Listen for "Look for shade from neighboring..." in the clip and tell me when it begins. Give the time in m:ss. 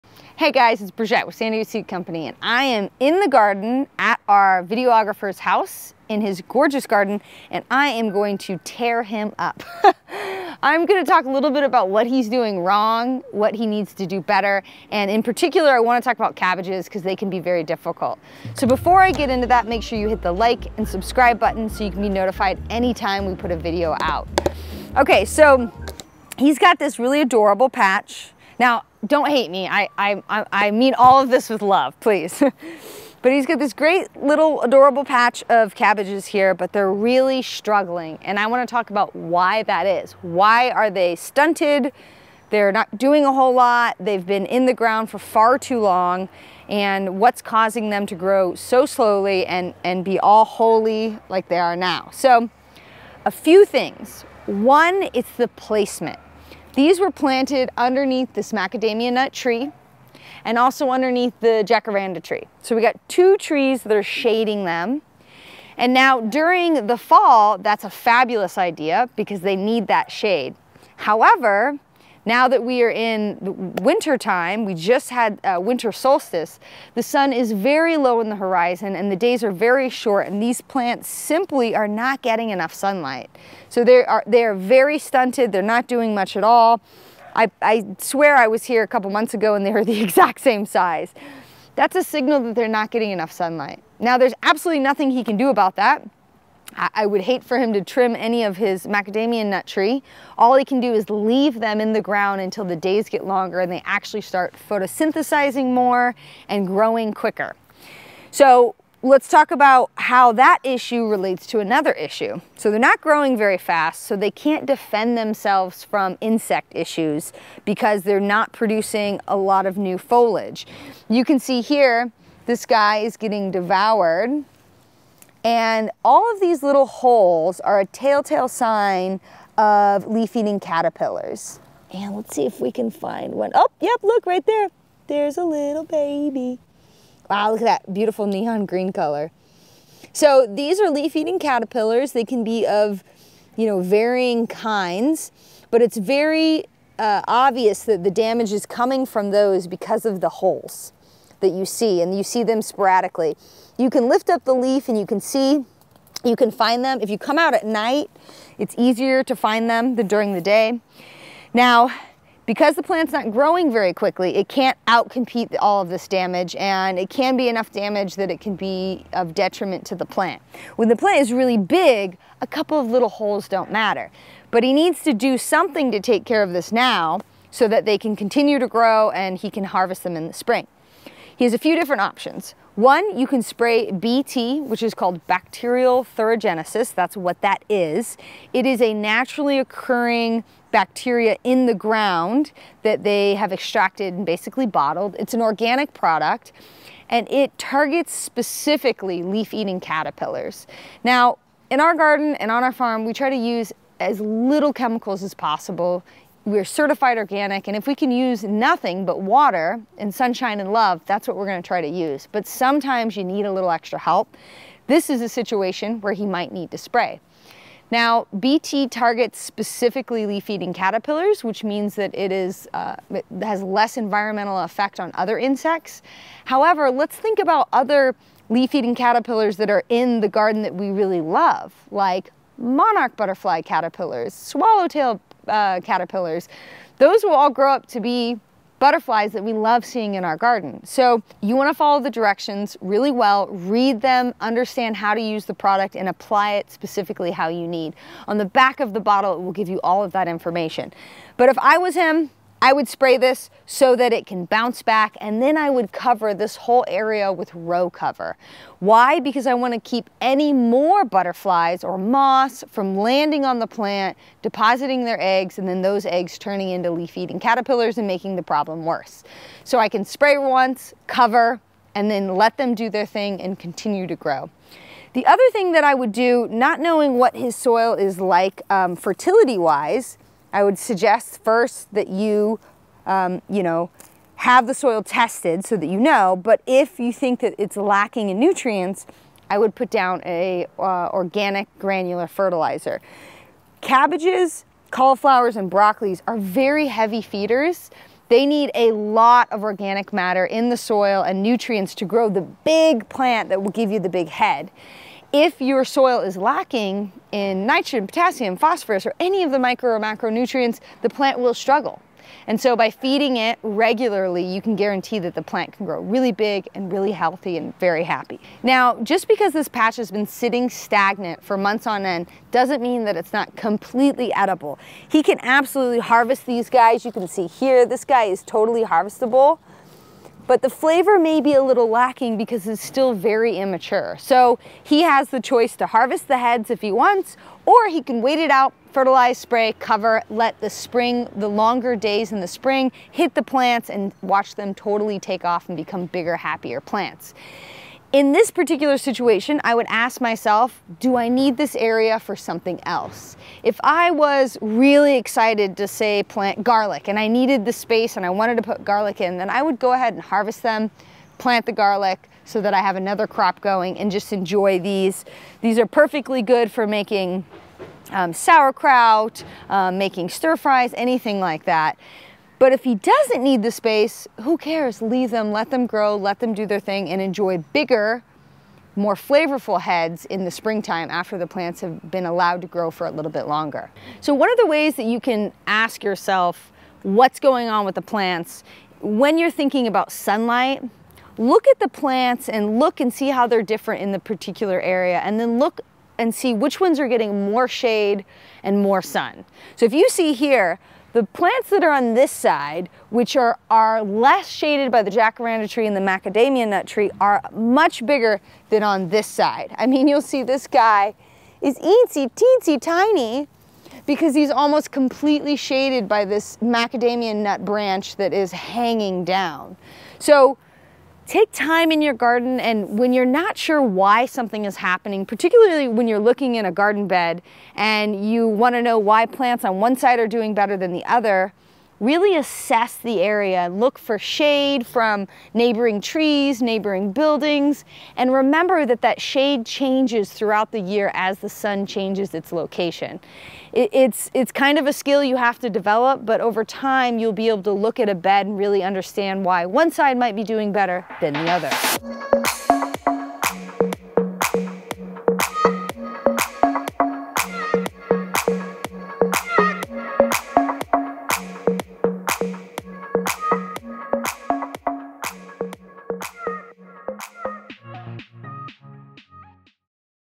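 7:13.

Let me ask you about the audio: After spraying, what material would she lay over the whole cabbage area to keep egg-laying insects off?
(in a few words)
Row cover.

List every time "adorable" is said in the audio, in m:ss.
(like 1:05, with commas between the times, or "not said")
0:27, 0:34.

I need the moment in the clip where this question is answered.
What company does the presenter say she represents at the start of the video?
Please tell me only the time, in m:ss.
0:01.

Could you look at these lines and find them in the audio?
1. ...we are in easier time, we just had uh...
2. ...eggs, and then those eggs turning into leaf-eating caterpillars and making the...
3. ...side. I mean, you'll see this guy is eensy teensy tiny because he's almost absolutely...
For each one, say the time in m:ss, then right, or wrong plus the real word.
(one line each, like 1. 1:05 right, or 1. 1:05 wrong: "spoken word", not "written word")
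1. 1:12 wrong: "winter", not "easier"
2. 4:25 right
3. 6:49 wrong: "completely", not "absolutely".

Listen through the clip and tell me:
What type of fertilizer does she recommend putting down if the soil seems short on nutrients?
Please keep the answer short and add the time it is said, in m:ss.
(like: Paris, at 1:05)
Organic granular fertilizer, at 4:51.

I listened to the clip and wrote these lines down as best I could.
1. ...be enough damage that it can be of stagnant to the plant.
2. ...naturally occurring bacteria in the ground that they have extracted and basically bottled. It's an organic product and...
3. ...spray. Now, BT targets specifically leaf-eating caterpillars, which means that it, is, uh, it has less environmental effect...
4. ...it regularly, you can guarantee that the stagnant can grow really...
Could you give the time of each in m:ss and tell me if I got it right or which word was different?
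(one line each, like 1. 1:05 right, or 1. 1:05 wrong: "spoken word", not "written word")
1. 2:47 wrong: "detriment", not "stagnant"
2. 3:08 right
3. 3:36 right
4. 5:13 wrong: "plant", not "stagnant".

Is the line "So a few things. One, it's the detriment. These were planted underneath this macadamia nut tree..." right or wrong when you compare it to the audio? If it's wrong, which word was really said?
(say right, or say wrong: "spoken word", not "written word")
wrong: "placement", not "detriment".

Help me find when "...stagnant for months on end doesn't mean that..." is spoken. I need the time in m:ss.
5:20.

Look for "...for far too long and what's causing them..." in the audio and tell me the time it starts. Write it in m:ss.
0:45.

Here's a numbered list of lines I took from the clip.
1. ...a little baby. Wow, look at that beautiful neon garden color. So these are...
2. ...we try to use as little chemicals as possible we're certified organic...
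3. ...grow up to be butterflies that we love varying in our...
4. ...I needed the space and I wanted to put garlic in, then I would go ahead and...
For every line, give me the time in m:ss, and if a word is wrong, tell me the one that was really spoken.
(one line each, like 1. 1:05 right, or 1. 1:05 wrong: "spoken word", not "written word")
1. 2:15 wrong: "green", not "garden"
2. 3:23 right
3. 3:57 wrong: "seeing", not "varying"
4. 5:57 right.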